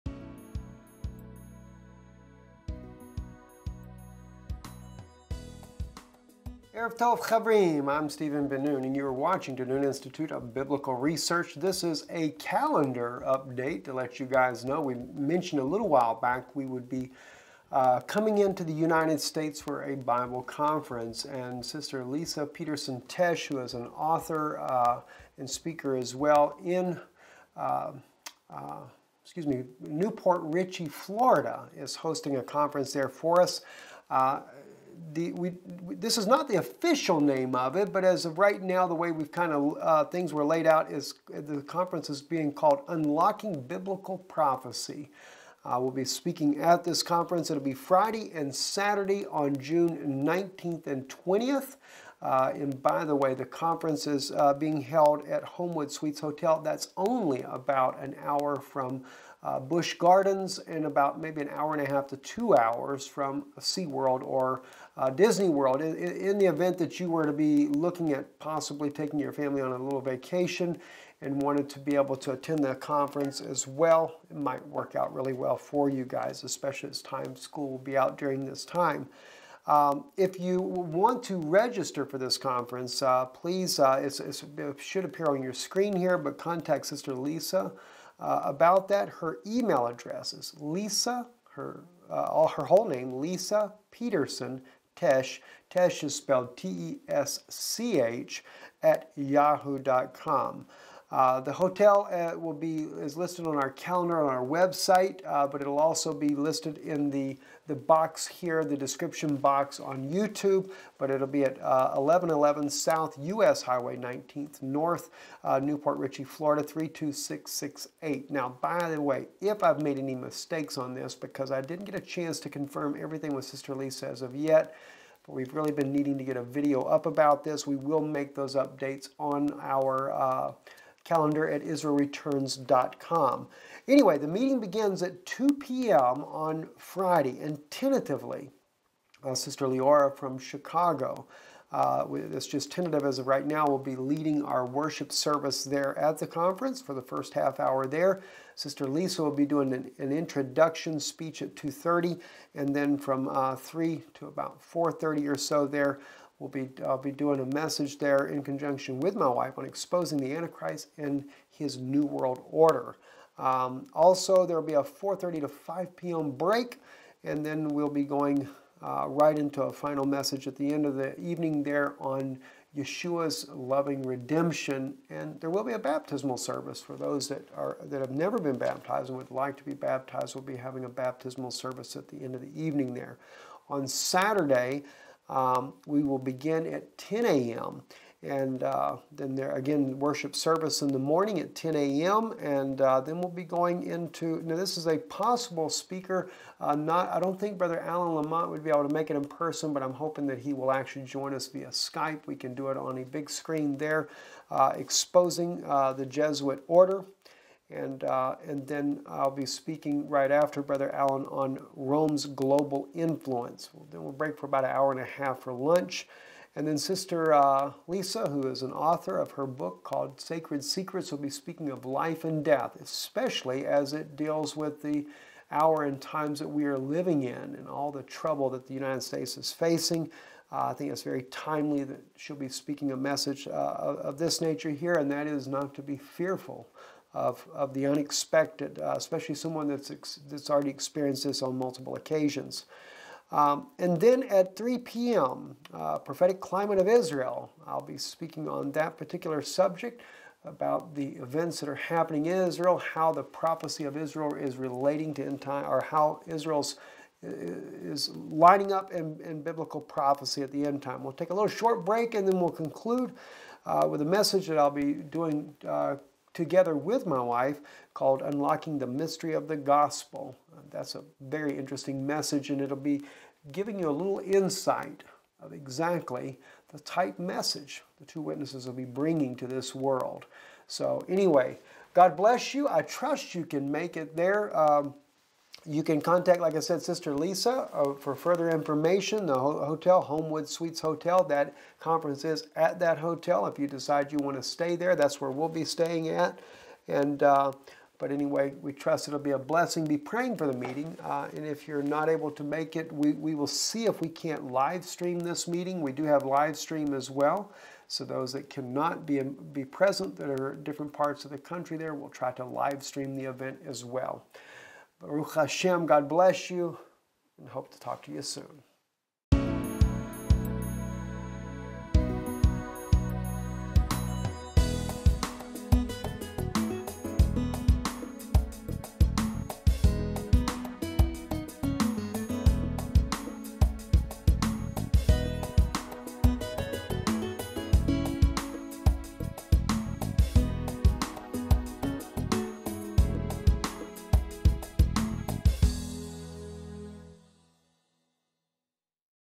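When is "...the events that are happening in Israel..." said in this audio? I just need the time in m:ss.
4:10.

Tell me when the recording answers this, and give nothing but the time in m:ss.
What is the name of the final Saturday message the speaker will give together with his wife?
4:28.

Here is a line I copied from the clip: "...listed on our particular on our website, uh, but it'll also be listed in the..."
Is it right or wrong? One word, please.
wrong.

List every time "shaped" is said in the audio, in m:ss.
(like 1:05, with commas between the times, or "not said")
not said.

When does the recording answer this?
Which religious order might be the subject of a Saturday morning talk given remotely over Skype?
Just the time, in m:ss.
3:26.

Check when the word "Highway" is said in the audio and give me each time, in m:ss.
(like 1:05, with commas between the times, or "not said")
1:53.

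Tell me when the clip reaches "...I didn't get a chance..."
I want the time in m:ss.
2:01.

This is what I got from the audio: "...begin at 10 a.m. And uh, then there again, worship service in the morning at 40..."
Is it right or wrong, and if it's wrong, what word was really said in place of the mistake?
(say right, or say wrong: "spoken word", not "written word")
wrong: "10", not "40".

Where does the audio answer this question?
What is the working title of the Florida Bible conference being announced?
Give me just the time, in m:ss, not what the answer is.
0:42.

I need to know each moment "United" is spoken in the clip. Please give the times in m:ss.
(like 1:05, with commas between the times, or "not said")
0:18, 3:48.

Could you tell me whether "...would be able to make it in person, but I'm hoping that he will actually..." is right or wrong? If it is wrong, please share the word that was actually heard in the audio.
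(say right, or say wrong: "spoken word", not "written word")
right.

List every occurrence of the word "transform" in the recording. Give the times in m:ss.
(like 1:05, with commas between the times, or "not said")
not said.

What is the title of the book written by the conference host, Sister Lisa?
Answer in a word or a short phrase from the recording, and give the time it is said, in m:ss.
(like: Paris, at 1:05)
Sacred Secrets, at 3:40.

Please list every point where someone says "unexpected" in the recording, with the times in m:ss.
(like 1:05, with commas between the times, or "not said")
3:57.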